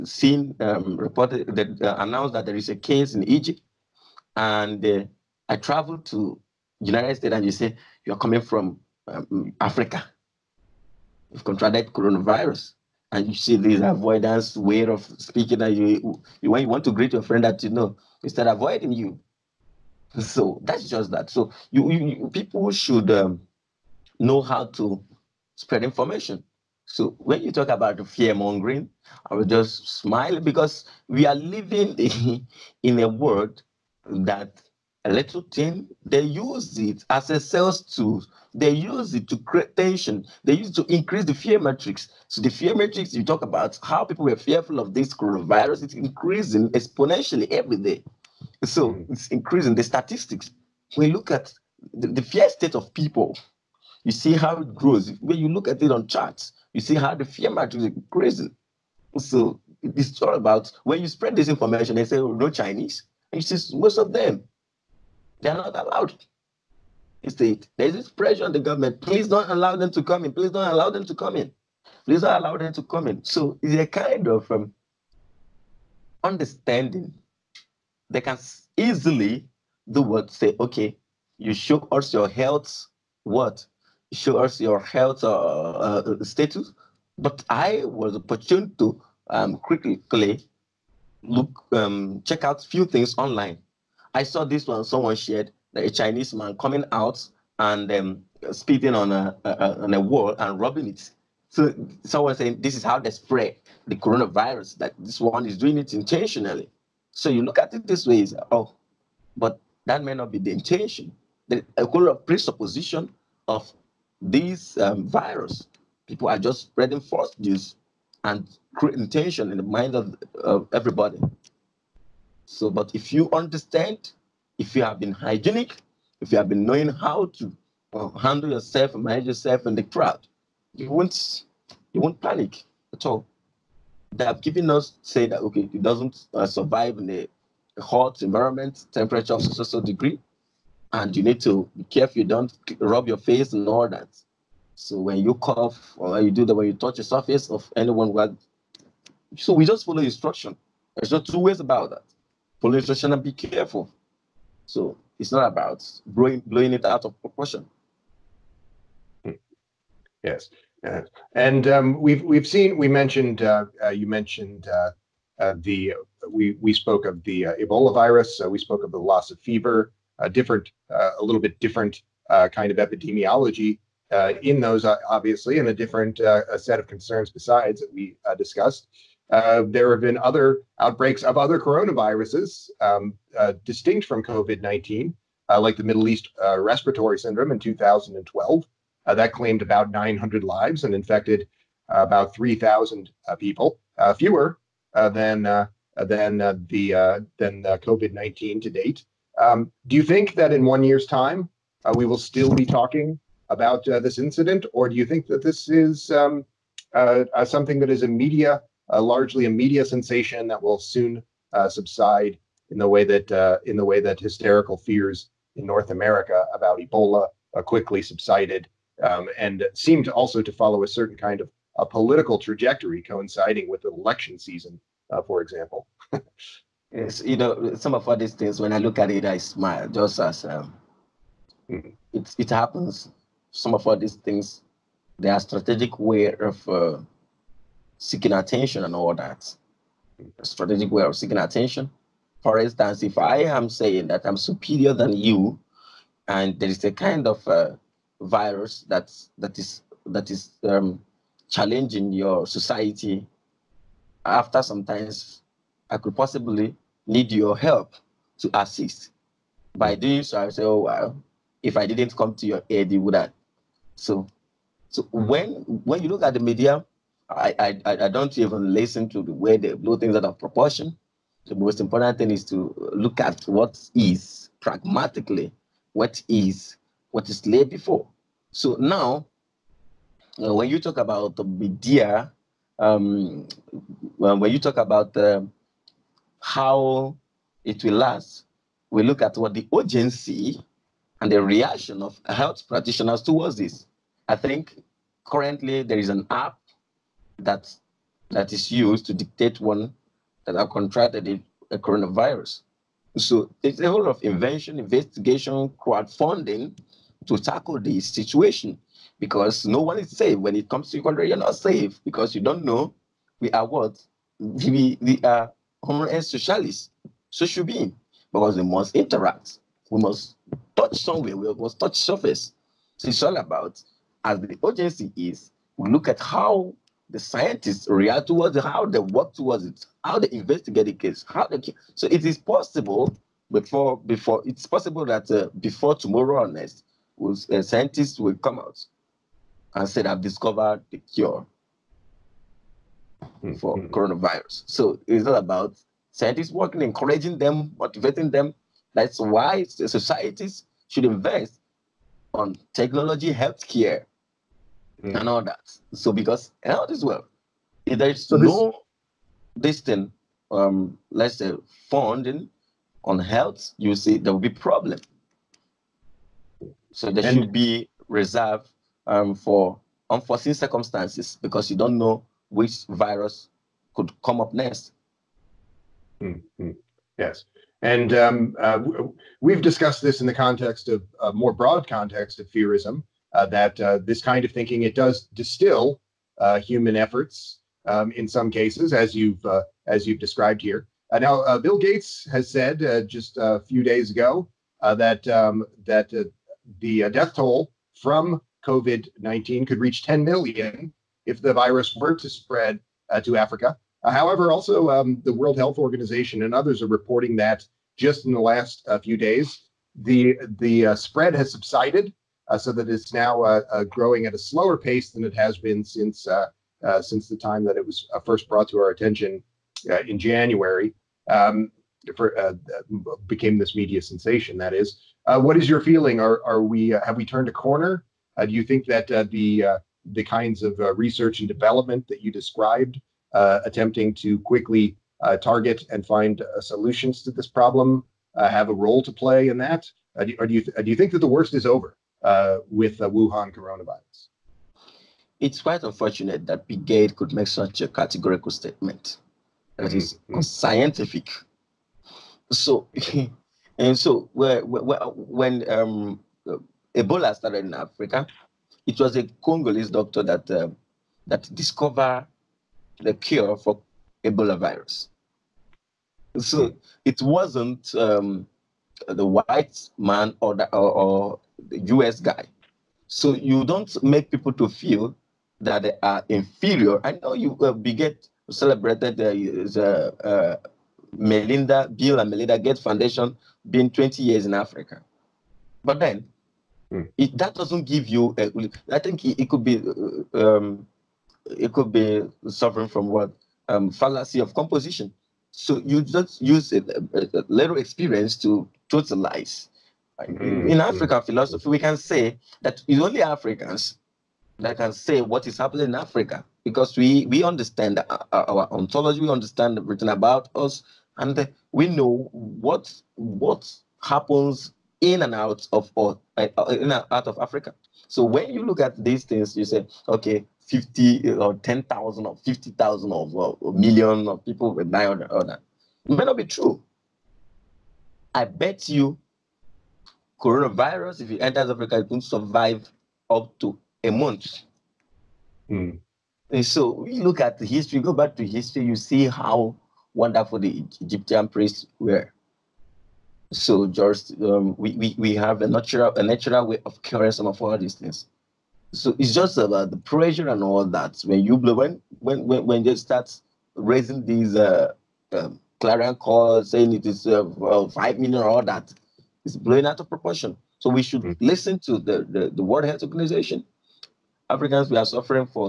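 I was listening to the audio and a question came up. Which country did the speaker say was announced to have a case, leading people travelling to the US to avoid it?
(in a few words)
Egypt.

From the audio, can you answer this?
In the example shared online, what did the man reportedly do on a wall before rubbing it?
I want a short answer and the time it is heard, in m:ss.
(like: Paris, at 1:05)
Spitting, at 1:38.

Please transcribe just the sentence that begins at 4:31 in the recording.
The most important thing is to look at what is pragmatically, what is what is laid before.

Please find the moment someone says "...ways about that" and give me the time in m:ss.
2:31.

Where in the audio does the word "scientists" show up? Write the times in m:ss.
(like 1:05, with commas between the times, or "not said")
5:27, 5:37, 5:46.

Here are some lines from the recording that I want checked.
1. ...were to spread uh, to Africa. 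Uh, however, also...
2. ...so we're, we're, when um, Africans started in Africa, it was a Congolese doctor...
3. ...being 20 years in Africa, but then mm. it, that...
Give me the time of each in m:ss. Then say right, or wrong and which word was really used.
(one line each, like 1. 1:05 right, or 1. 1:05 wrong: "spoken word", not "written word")
1. 6:41 right
2. 7:33 wrong: "Ebola", not "Africans"
3. 8:03 right.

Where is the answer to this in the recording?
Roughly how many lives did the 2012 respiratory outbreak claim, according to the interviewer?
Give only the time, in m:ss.
3:09.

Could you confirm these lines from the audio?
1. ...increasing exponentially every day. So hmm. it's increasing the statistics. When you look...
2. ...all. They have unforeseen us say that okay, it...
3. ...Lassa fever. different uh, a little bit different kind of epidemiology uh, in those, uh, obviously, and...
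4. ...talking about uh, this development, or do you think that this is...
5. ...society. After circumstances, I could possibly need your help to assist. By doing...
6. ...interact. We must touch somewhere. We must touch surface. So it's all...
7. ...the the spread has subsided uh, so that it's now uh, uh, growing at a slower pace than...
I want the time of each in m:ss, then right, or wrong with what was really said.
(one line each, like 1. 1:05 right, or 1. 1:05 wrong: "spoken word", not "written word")
1. 0:45 right
2. 2:13 wrong: "given", not "unforeseen"
3. 2:48 right
4. 3:22 wrong: "incident", not "development"
5. 4:12 wrong: "sometimes", not "circumstances"
6. 5:18 right
7. 6:49 right.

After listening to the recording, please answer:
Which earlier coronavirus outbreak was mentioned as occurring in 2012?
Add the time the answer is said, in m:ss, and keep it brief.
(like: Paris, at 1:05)
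Middle East respiratory syndrome, at 3:05.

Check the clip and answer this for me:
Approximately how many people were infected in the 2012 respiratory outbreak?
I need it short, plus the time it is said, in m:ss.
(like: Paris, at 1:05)
About 3,000, at 3:11.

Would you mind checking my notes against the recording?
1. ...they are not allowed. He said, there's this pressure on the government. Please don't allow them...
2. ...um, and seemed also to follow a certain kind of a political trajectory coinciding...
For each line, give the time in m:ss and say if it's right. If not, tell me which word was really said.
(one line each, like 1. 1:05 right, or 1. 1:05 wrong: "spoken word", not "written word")
1. 1:05 right
2. 3:39 right.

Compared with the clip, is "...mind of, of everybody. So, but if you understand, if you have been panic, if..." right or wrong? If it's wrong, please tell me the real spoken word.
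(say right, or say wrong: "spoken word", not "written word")
wrong: "hygienic", not "panic".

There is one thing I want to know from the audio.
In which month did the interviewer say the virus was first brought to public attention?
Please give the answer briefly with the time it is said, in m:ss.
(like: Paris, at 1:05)
January, at 7:00.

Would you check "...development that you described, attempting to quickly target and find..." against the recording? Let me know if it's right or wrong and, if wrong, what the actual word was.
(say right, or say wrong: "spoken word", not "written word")
right.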